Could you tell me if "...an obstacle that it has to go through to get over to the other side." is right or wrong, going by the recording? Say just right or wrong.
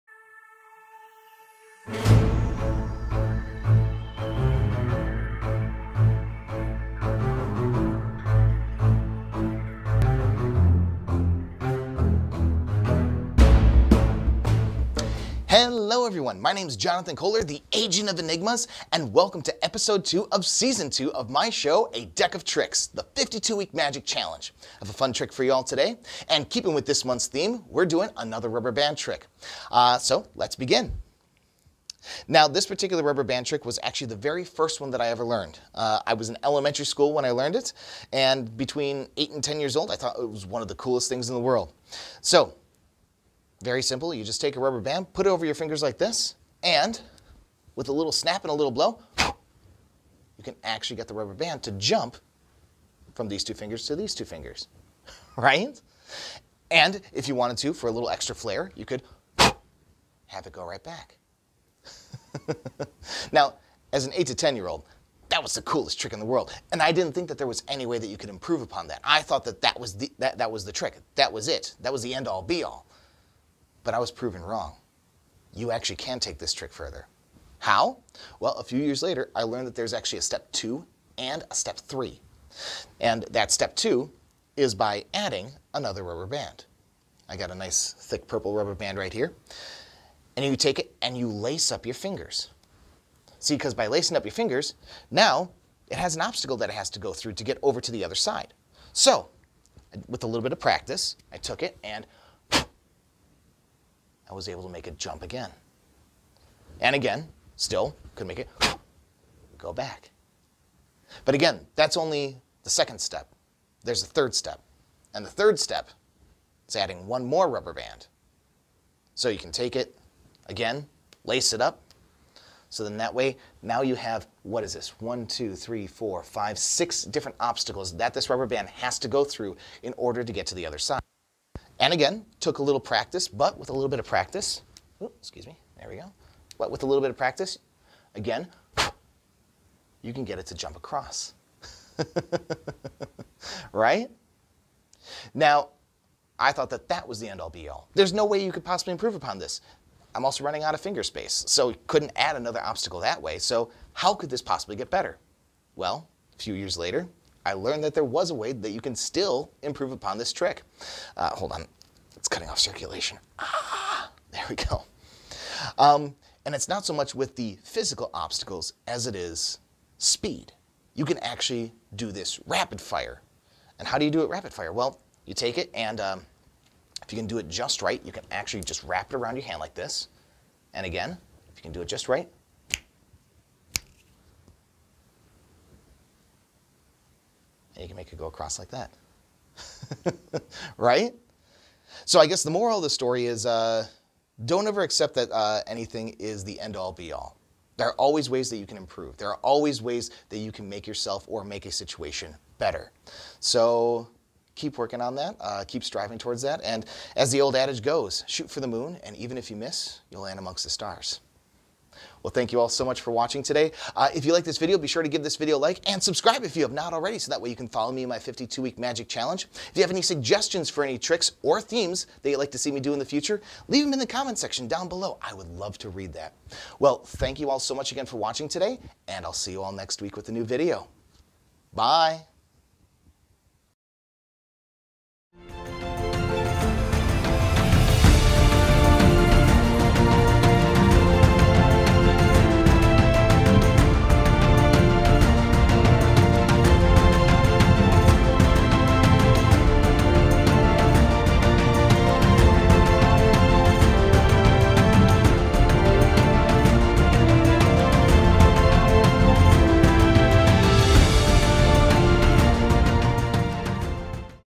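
right.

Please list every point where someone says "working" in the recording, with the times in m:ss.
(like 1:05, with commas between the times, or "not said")
3:24.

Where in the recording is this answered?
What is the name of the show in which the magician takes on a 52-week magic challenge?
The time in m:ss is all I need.
0:21.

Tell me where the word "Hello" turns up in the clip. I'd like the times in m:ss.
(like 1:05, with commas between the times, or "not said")
0:15.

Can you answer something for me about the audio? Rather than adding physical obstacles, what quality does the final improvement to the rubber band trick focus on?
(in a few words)
Speed.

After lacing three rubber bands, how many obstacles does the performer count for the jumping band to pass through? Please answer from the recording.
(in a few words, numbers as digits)
6.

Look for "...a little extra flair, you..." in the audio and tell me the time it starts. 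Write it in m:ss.
0:57.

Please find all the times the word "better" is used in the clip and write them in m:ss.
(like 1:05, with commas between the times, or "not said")
2:34, 3:22.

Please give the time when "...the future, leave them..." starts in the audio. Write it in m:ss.
3:42.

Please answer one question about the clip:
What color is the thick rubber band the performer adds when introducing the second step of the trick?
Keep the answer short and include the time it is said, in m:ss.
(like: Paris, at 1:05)
Purple, at 1:28.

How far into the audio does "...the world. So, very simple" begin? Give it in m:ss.
0:41.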